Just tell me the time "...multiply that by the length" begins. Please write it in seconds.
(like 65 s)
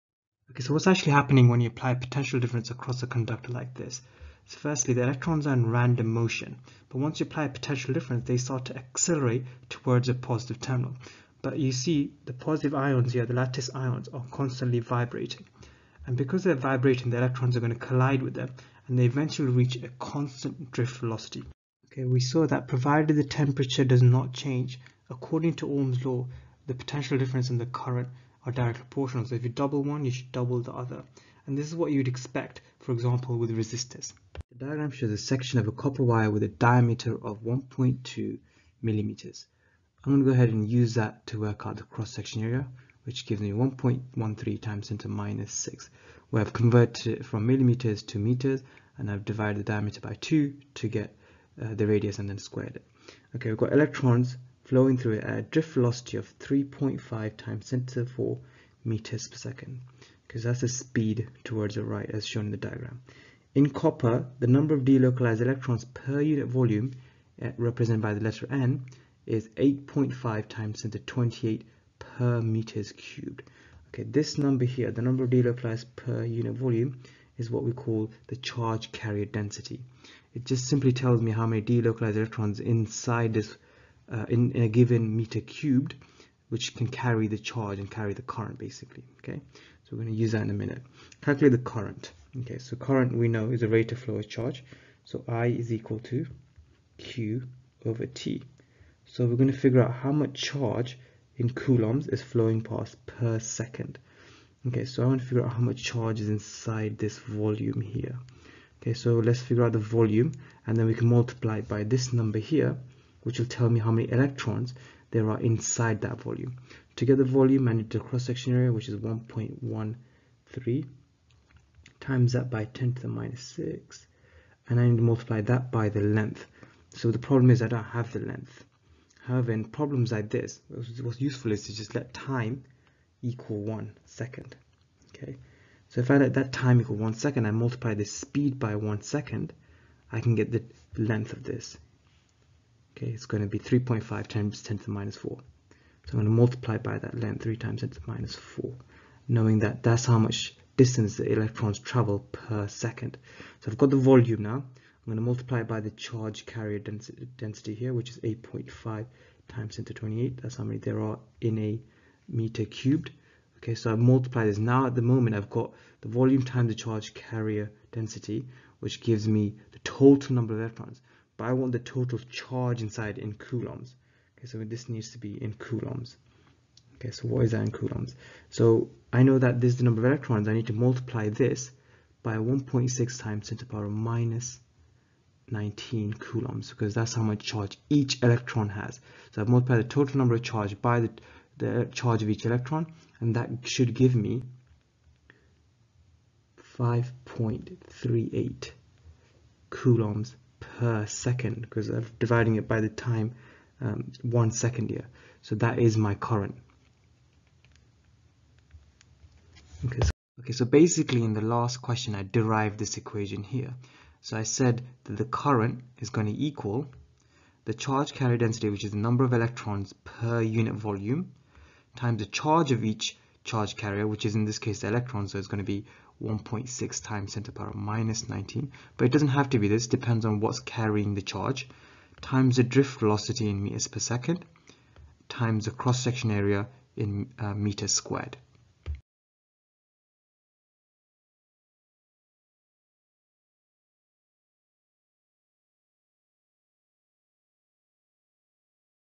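125 s.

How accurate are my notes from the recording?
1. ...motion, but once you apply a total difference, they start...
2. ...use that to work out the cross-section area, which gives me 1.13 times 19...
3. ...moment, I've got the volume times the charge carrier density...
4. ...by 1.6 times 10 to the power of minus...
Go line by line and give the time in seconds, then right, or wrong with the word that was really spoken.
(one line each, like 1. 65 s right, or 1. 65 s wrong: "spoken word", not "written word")
1. 6 s wrong: "potential", not "total"
2. 40 s wrong: "10", not "19"
3. 165 s right
4. 182 s right.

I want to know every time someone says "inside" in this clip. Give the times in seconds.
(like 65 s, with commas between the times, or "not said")
82 s, 106 s, 115 s, 172 s.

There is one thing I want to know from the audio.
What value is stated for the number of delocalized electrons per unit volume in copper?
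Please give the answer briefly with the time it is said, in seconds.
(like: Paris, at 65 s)
8.5 × 10^28 per cubic meter, at 69 s.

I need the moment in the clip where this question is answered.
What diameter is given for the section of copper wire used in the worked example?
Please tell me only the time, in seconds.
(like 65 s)
37 s.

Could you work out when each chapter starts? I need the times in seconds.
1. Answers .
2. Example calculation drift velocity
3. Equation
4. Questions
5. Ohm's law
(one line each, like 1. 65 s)
1. 244 s
2. 34 s
3. 209 s
4. 219 s
5. 21 s.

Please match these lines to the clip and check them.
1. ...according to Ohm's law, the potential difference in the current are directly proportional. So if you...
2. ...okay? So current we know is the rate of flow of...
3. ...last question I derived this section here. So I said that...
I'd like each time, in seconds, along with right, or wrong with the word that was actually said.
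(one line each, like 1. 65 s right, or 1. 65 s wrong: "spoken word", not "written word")
1. 25 s right
2. 92 s right
3. 211 s wrong: "equation", not "section".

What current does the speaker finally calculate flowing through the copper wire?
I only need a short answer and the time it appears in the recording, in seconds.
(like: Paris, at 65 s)
5.38 coulombs per second, at 196 s.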